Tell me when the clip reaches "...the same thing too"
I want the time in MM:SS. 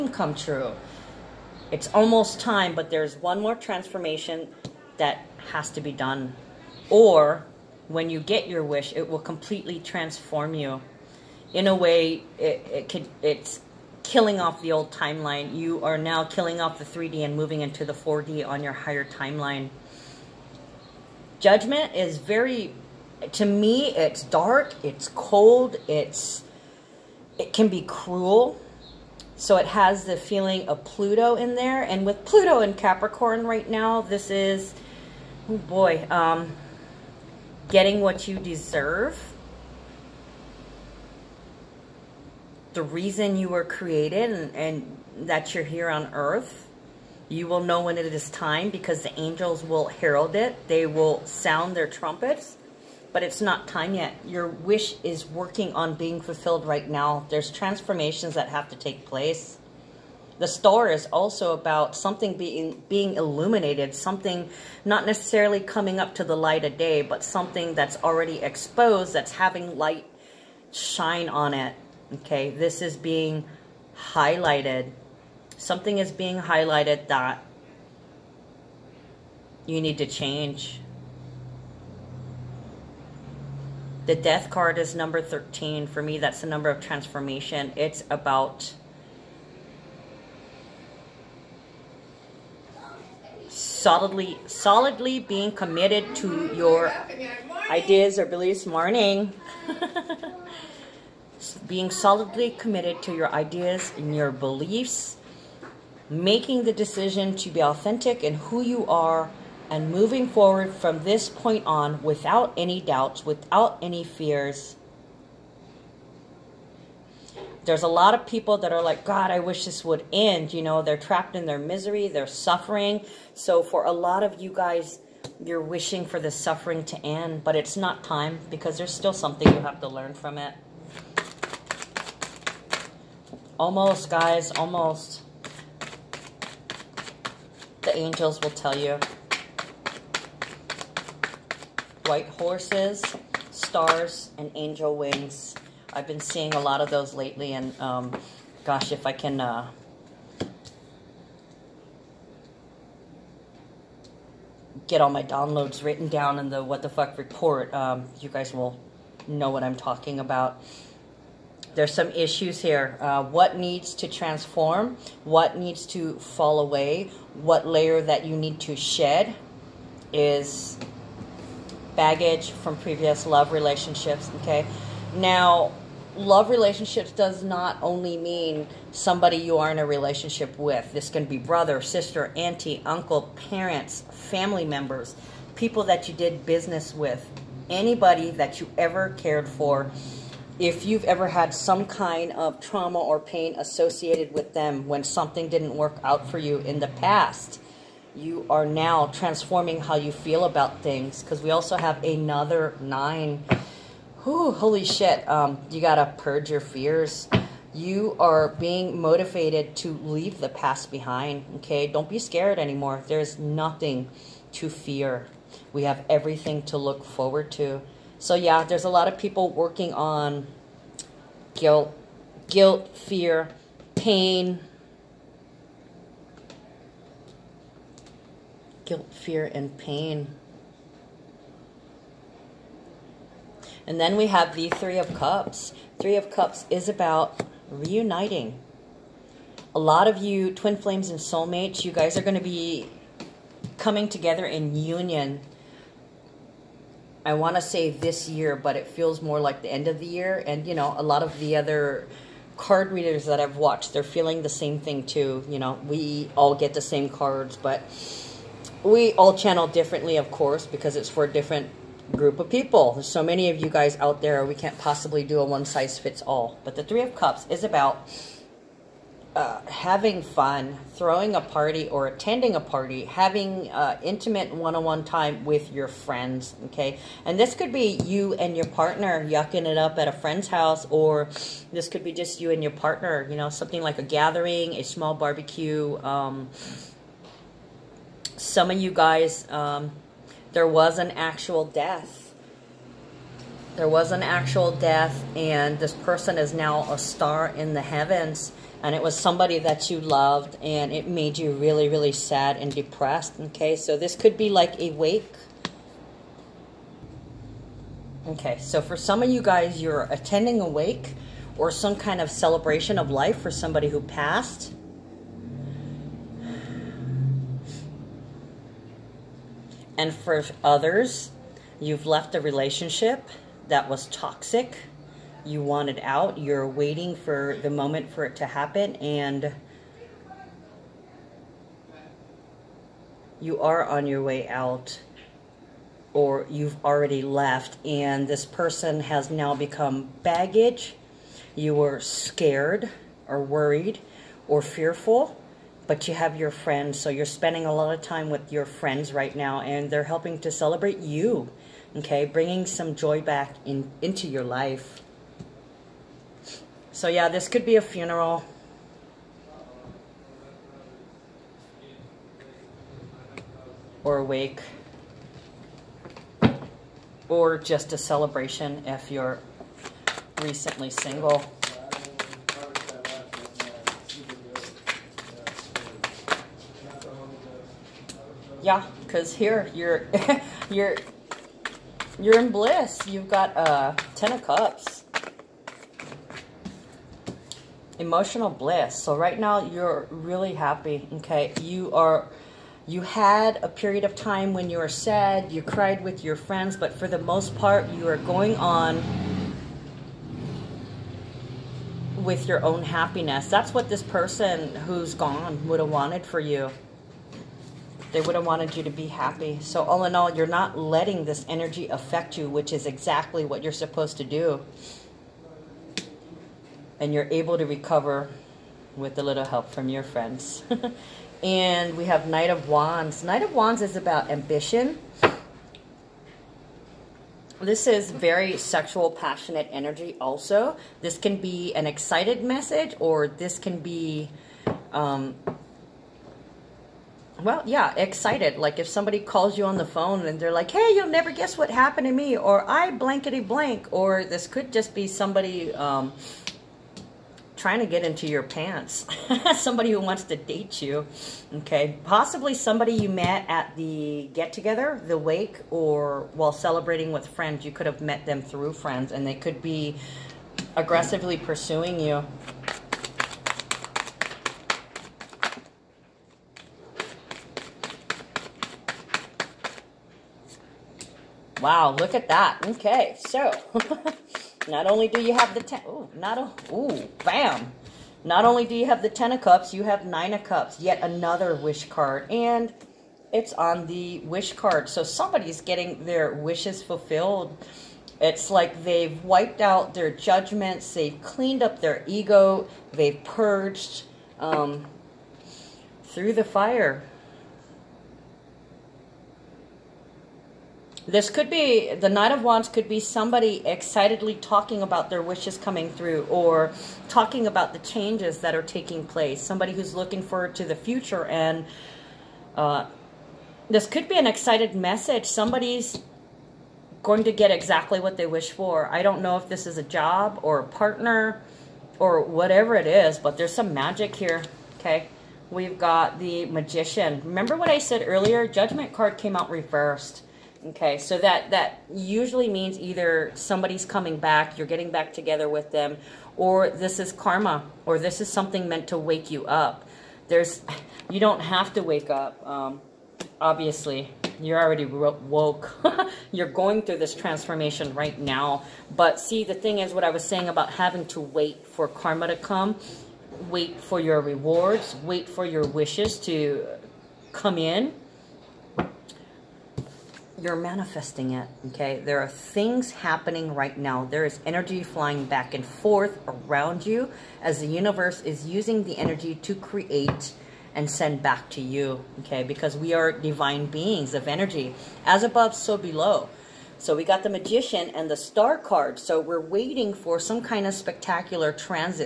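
04:14.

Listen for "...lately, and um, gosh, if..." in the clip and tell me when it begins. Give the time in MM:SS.
02:27.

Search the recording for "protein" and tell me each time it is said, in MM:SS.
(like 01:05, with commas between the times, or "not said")
not said.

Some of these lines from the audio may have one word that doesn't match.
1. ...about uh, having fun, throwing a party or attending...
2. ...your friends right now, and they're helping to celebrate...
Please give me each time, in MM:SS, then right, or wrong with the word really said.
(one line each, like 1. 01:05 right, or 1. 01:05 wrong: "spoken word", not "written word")
1. 04:27 right
2. 05:48 right.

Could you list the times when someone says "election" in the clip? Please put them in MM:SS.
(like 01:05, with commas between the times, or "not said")
not said.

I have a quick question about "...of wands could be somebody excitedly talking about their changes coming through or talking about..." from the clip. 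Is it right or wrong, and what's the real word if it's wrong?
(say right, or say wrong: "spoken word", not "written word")
wrong: "wishes", not "changes".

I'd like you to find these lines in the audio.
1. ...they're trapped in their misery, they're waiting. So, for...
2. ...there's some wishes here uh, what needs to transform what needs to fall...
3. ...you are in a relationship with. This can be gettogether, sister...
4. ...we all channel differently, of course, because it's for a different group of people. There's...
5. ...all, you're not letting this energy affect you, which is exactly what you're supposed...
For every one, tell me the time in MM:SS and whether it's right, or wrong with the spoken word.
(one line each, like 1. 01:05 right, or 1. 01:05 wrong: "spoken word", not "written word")
1. 02:00 wrong: "suffering", not "waiting"
2. 02:41 wrong: "issues", not "wishes"
3. 02:59 wrong: "brother", not "gettogether"
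4. 04:18 right
5. 06:50 right.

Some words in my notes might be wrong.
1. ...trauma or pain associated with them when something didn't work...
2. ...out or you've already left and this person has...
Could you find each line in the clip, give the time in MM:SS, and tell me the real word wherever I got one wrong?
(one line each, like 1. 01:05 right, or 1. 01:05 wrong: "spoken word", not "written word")
1. 03:12 right
2. 05:34 right.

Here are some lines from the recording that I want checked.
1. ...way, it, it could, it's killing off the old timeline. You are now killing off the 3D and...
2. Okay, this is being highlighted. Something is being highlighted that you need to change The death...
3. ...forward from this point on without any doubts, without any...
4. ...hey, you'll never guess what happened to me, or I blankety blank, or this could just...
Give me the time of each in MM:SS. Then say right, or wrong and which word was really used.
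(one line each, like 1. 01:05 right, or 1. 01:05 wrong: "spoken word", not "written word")
1. 00:11 right
2. 01:12 right
3. 01:50 right
4. 07:20 right.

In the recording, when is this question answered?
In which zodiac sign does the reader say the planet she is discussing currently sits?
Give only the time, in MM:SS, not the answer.
00:32.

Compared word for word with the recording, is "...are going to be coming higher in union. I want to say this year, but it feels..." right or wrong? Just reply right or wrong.
wrong.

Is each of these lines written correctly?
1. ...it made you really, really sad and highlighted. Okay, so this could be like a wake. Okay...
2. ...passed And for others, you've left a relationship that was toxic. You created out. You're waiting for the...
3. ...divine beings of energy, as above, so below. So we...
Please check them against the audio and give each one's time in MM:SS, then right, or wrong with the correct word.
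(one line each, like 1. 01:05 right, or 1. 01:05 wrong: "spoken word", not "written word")
1. 05:00 wrong: "depressed", not "highlighted"
2. 05:14 wrong: "wanted", not "created"
3. 09:33 right.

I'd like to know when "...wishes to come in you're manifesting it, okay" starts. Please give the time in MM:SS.
09:15.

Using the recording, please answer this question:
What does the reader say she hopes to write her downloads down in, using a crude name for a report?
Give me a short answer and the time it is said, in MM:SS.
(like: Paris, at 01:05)
the what the fuck report, at 02:36.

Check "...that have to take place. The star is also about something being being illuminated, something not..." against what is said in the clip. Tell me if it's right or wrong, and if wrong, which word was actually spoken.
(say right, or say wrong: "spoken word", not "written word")
right.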